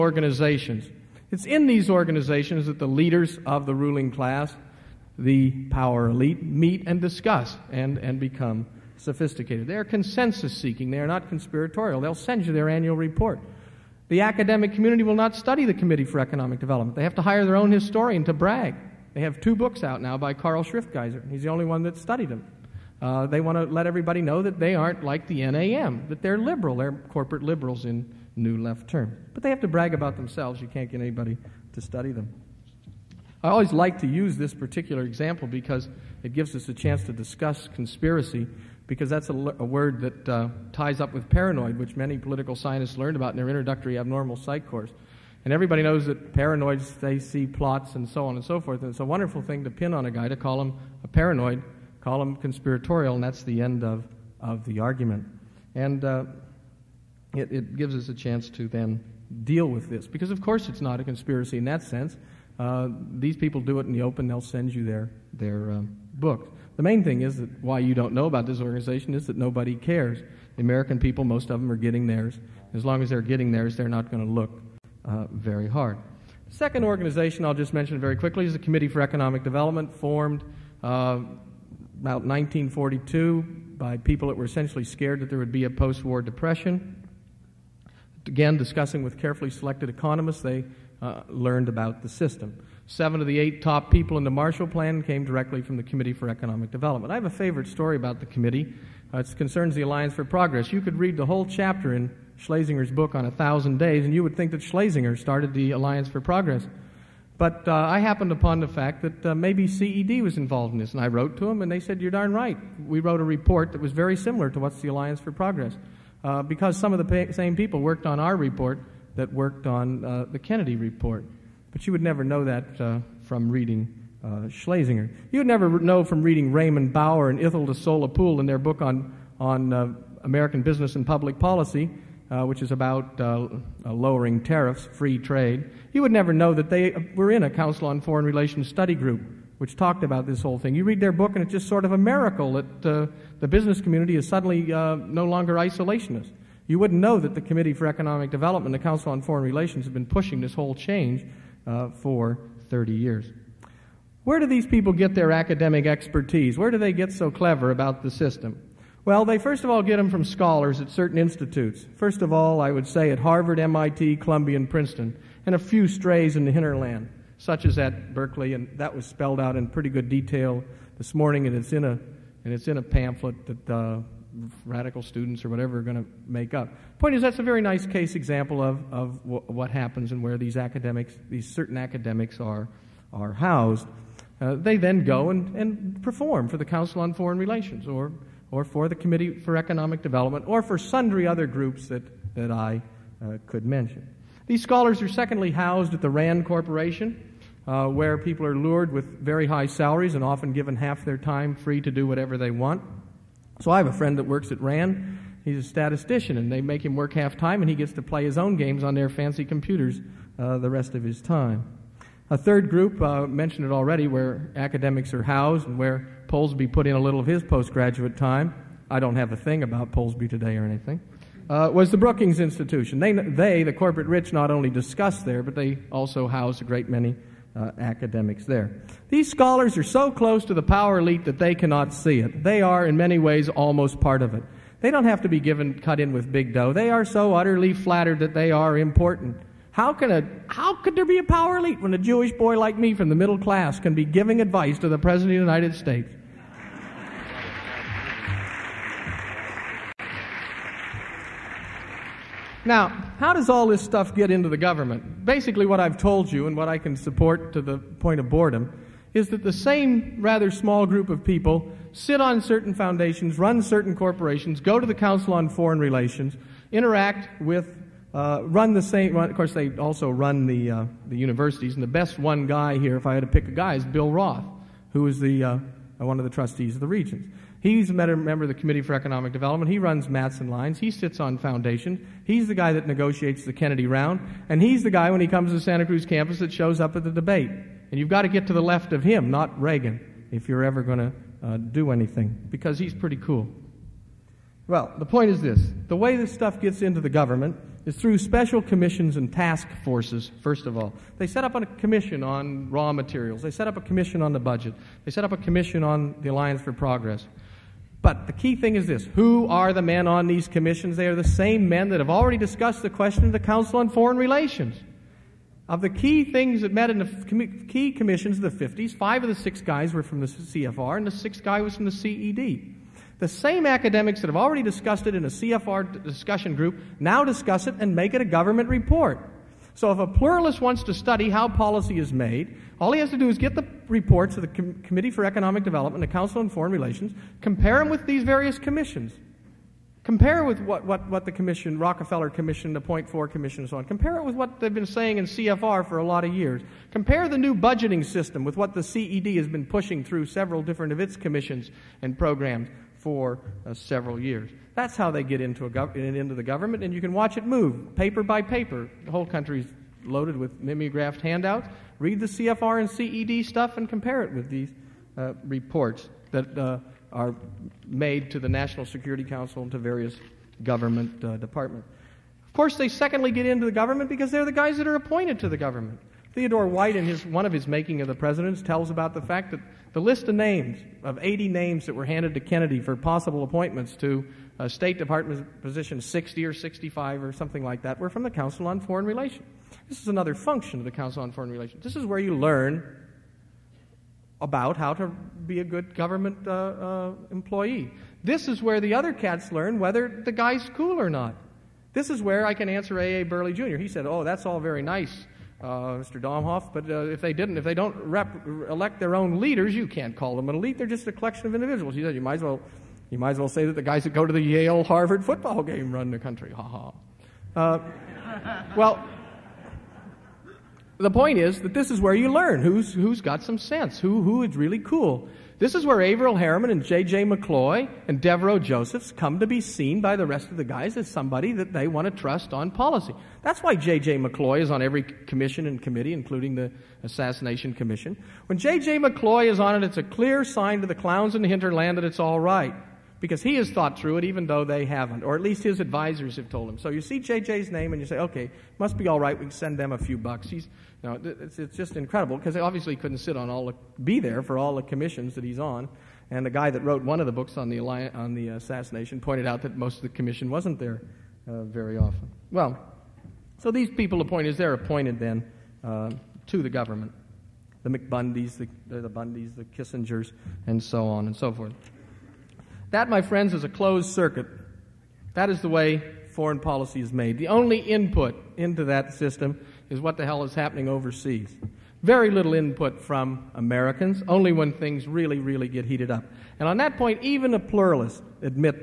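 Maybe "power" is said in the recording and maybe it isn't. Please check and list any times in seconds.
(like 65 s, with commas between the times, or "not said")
5 s, 230 s, 241 s.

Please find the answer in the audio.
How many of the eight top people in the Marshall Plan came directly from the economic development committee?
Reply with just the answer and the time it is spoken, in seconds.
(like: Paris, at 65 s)
7, at 92 s.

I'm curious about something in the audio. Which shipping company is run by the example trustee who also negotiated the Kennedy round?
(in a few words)
Matson Lines.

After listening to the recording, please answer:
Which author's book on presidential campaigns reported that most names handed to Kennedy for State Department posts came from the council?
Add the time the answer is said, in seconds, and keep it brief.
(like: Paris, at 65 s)
Theodore White, at 376 s.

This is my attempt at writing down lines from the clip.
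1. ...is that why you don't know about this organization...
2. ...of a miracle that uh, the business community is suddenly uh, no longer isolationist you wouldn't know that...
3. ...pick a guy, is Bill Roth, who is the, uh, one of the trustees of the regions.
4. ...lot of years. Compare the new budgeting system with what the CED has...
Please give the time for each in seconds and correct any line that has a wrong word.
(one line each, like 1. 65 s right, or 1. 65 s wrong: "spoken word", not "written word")
1. 67 s right
2. 141 s right
3. 273 s right
4. 346 s right.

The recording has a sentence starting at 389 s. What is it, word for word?
This is another function of the Council on Foreign Relations.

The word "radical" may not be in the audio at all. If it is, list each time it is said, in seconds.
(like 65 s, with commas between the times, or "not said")
174 s.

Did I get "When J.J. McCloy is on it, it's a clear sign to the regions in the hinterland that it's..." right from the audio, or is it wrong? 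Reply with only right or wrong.
wrong.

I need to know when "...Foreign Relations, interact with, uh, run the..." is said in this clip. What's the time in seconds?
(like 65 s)
265 s.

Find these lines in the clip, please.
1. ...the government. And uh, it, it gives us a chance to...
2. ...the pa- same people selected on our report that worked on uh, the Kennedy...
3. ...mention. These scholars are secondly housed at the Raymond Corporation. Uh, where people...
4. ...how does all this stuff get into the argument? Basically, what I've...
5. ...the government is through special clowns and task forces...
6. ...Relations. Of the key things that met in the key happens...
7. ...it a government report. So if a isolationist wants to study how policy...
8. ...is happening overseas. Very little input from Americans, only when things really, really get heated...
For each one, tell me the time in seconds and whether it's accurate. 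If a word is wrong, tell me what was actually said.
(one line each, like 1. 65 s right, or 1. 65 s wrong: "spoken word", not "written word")
1. 54 s wrong: "argument", not "government"
2. 117 s wrong: "worked", not "selected"
3. 193 s wrong: "RAND", not "Raymond"
4. 253 s wrong: "government", not "argument"
5. 297 s wrong: "commissions", not "clowns"
6. 314 s wrong: "commissions", not "happens"
7. 328 s wrong: "pluralist", not "isolationist"
8. 480 s right.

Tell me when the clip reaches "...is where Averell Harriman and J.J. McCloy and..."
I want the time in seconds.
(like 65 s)
425 s.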